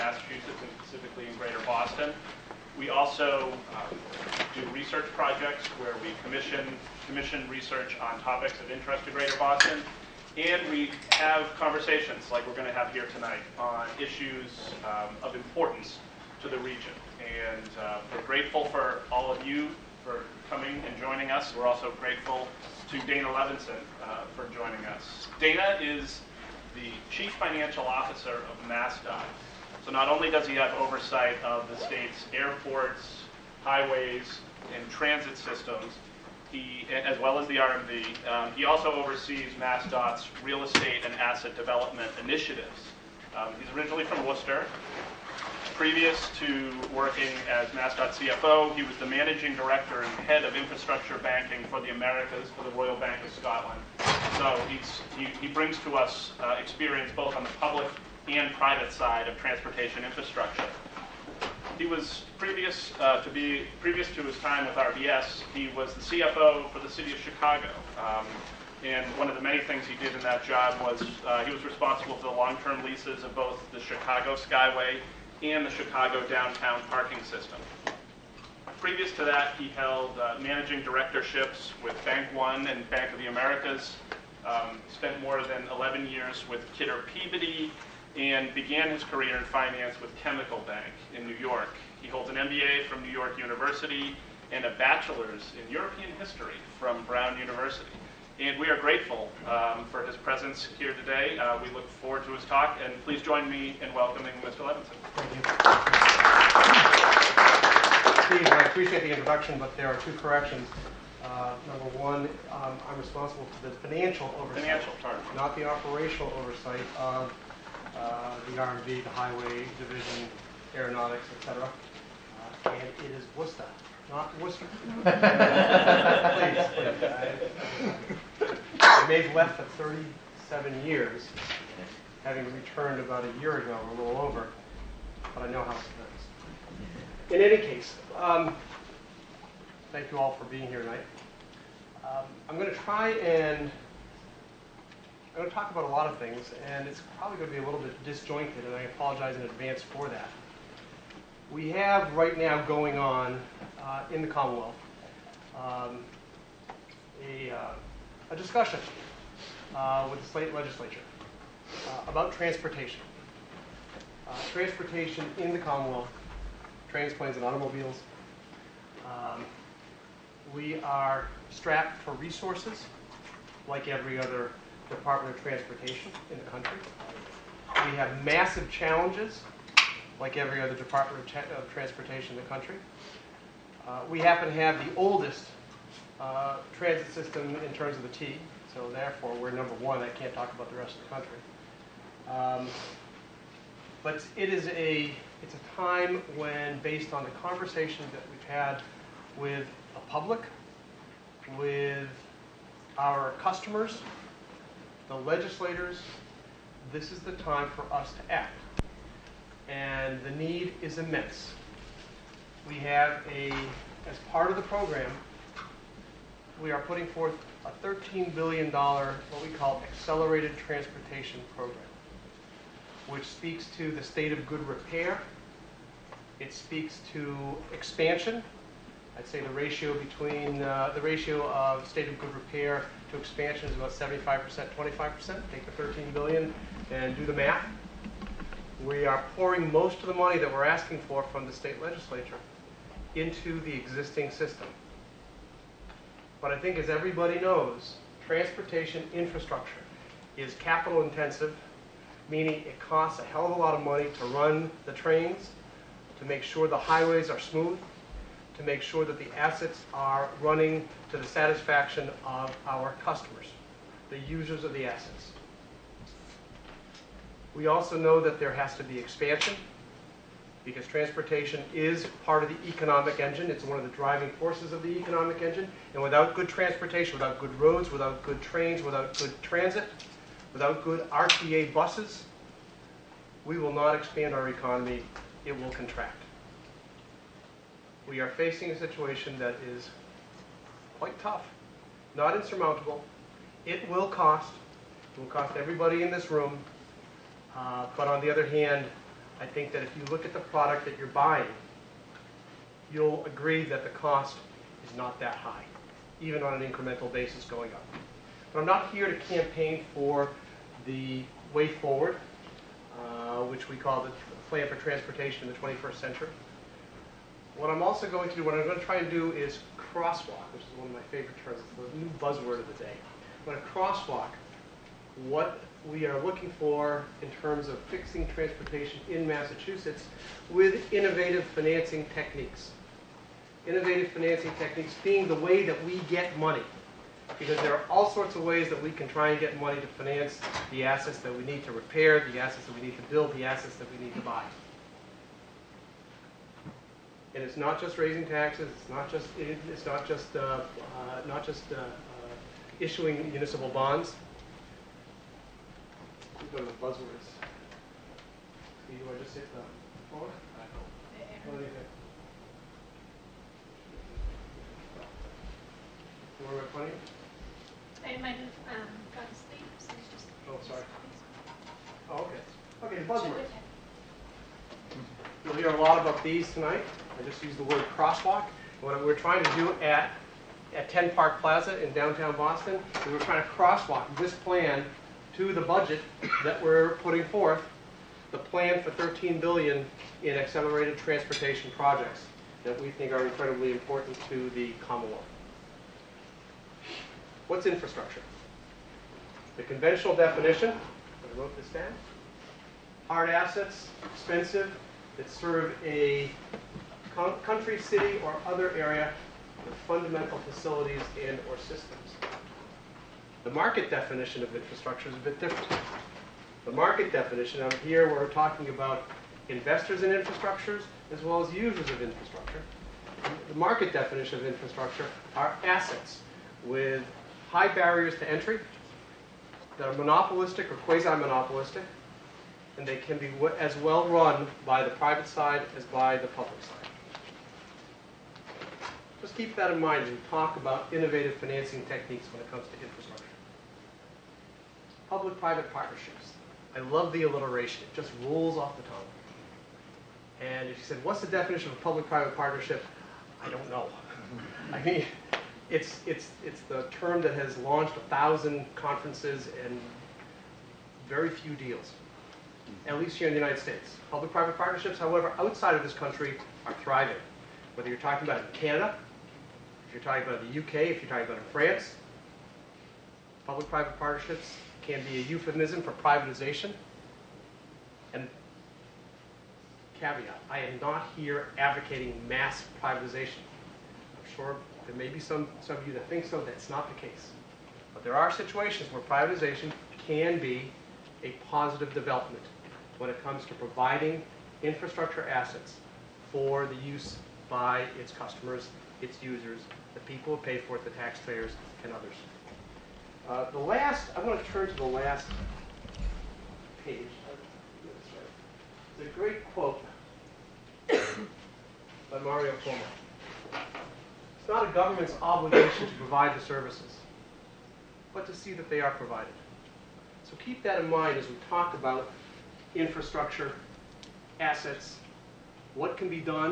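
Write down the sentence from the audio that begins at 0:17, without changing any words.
And uh, we're grateful for all of you for coming and joining us.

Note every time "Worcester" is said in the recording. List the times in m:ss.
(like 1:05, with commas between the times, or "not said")
0:44, 2:04.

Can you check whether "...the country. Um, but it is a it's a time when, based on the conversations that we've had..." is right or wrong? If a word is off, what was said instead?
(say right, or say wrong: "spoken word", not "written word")
right.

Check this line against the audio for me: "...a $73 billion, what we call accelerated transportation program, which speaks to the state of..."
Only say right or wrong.
wrong.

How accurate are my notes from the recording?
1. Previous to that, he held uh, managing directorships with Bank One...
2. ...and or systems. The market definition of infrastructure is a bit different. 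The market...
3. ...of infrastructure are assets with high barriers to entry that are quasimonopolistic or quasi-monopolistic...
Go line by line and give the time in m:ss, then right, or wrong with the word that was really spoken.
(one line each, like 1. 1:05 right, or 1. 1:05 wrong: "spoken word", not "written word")
1. 1:18 right
2. 6:51 right
3. 7:04 wrong: "monopolistic", not "quasimonopolistic".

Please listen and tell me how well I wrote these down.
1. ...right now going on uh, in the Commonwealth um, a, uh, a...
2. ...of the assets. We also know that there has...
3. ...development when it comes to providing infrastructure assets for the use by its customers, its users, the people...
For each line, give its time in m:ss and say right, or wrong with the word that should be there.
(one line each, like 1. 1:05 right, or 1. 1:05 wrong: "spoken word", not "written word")
1. 2:32 right
2. 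4:24 right
3. 8:11 right.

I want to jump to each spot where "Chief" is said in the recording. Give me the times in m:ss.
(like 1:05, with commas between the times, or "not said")
0:27.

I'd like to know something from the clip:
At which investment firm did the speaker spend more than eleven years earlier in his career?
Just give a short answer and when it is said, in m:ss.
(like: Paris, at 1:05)
Kidder Peabody, at 1:26.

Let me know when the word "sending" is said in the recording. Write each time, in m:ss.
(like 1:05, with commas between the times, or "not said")
not said.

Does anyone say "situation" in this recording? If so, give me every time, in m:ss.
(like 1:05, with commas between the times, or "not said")
4:48, 8:08.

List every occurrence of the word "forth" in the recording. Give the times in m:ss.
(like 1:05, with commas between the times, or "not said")
3:37, 6:27.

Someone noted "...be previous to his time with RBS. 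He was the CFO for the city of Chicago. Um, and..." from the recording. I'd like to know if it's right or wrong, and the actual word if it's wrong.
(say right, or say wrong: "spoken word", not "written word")
right.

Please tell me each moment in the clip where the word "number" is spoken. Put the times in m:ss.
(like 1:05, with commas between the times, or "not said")
1:51, 3:09.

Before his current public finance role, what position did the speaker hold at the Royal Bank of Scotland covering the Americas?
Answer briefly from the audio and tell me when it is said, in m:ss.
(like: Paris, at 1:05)
Head of infrastructure banking, at 0:50.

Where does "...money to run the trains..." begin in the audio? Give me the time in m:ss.
4:13.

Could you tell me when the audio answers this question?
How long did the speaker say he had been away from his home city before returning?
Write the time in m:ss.
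2:09.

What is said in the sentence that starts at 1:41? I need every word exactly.
Uh, we look forward to his talk, and please join me in welcoming Mr.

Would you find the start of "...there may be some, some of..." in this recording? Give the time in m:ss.
8:04.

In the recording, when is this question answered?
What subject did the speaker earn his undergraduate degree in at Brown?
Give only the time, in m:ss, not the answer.
1:35.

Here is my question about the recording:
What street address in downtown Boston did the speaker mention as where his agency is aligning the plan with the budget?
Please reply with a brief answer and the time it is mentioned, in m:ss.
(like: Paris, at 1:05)
10 Park Plaza, at 6:20.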